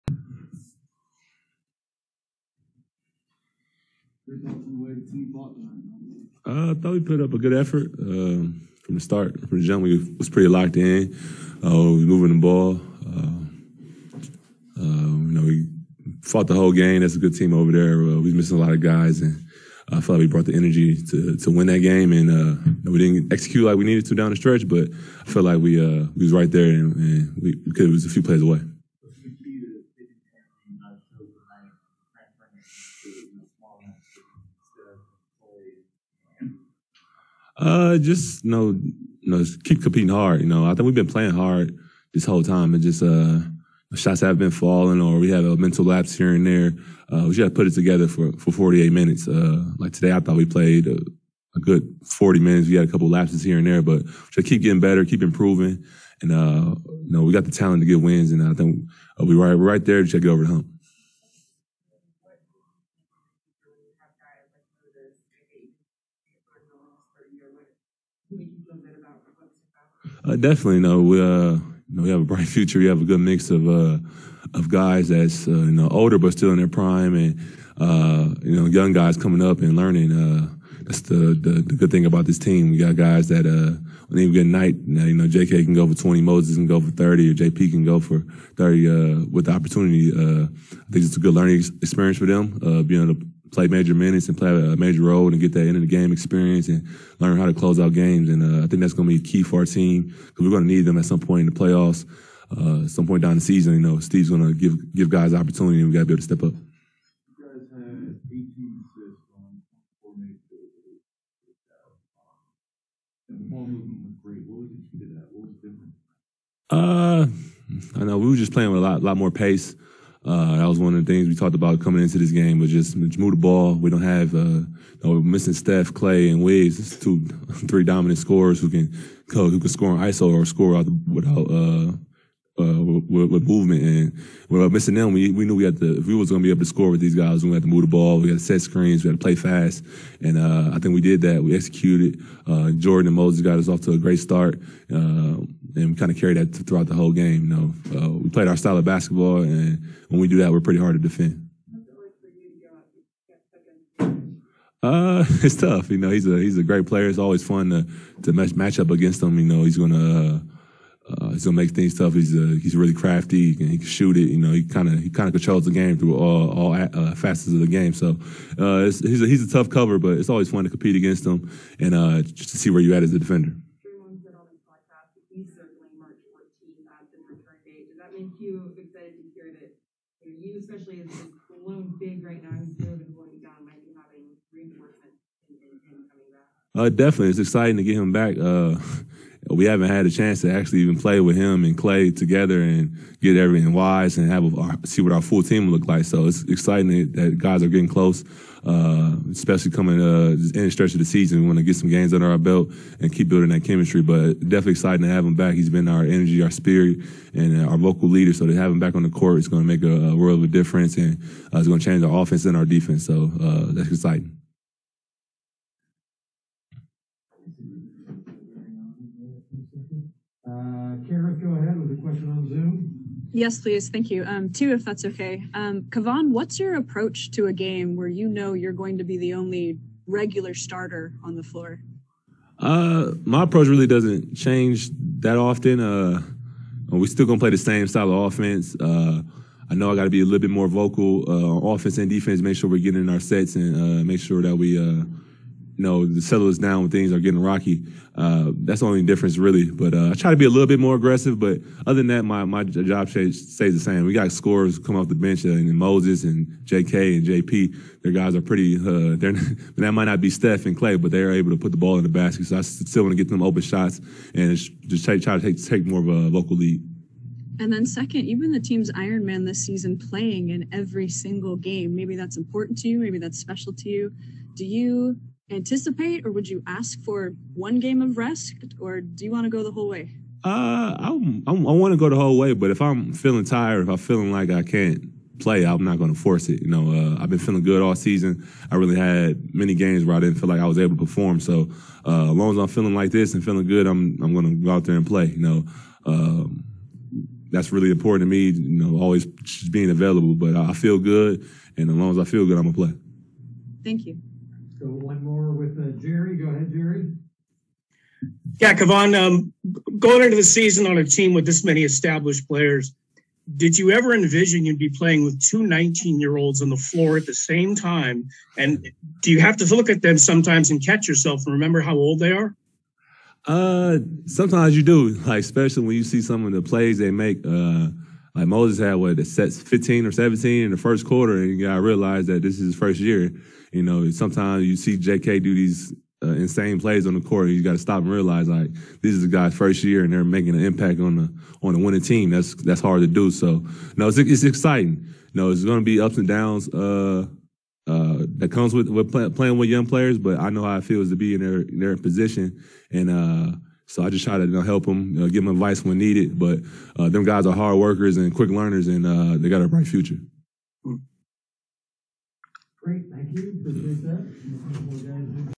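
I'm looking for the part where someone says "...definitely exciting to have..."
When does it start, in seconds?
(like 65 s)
204 s.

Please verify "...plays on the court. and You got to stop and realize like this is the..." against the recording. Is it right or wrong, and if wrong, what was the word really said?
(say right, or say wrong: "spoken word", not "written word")
right.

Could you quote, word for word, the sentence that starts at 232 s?
Uh, my approach really doesn't change that often.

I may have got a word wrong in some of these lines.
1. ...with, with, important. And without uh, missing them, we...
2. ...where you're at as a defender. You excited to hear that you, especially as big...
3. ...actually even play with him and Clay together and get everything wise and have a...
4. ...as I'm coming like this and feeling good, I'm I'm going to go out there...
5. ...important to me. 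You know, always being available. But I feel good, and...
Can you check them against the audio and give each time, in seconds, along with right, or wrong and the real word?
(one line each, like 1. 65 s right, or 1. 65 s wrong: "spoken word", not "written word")
1. 133 s wrong: "movement", not "important"
2. 172 s right
3. 190 s right
4. 292 s wrong: "feeling", not "coming"
5. 297 s right.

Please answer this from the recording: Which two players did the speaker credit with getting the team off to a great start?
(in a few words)
Jordan and Moses.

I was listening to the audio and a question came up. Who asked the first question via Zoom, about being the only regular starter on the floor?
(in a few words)
Kara.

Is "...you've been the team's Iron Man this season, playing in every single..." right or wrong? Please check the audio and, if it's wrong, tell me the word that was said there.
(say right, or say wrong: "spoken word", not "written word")
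right.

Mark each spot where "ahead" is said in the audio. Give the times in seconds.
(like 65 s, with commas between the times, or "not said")
221 s, 306 s.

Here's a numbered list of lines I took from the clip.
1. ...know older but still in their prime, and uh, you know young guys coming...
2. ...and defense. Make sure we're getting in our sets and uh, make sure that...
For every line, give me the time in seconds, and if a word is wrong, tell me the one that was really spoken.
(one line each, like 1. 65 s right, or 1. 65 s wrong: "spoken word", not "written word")
1. 75 s right
2. 241 s right.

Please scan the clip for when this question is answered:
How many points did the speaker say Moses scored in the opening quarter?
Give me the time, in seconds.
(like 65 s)
329 s.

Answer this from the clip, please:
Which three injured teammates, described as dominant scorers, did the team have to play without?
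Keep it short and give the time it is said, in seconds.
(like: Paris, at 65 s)
Steph, Clay, and Wiz, at 125 s.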